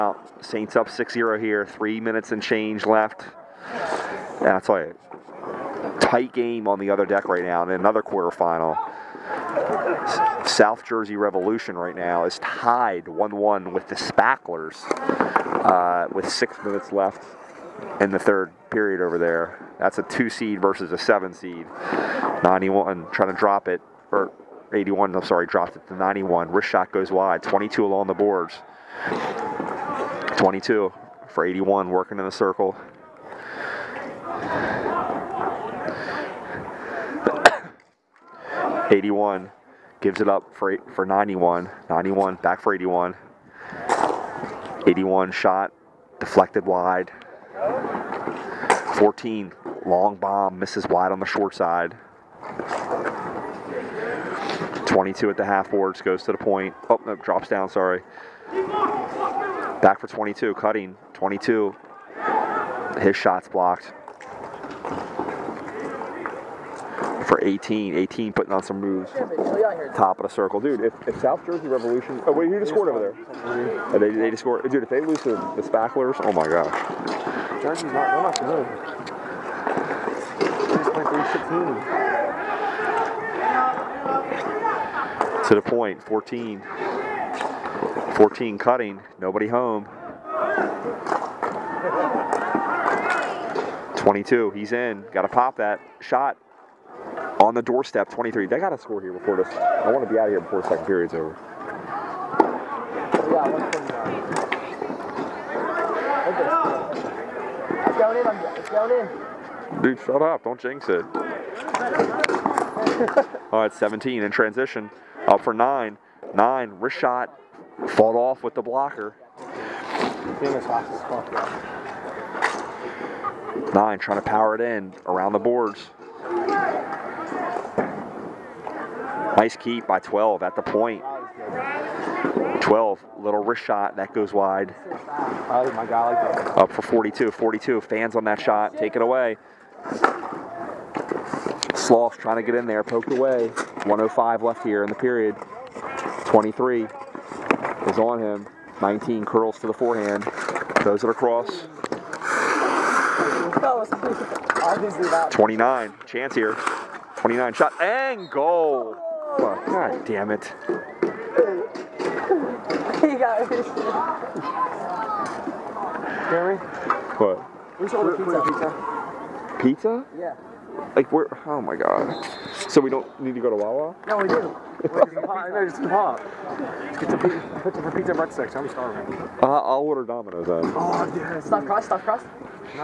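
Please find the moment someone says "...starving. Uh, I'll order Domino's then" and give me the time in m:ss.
2:58.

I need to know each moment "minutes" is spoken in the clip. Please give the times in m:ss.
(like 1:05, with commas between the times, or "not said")
0:01, 0:16.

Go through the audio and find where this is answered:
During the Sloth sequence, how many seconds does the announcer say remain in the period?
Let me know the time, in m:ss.
2:23.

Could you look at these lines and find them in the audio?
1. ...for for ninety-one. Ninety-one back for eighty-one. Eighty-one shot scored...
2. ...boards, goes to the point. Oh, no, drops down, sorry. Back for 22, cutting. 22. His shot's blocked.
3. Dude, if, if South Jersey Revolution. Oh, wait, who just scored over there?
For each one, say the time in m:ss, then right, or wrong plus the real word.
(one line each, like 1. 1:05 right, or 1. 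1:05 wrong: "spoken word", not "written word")
1. 0:40 wrong: "deflected", not "scored"
2. 0:55 right
3. 1:10 right.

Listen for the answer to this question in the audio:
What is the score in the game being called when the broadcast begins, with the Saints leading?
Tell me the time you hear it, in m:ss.
0:00.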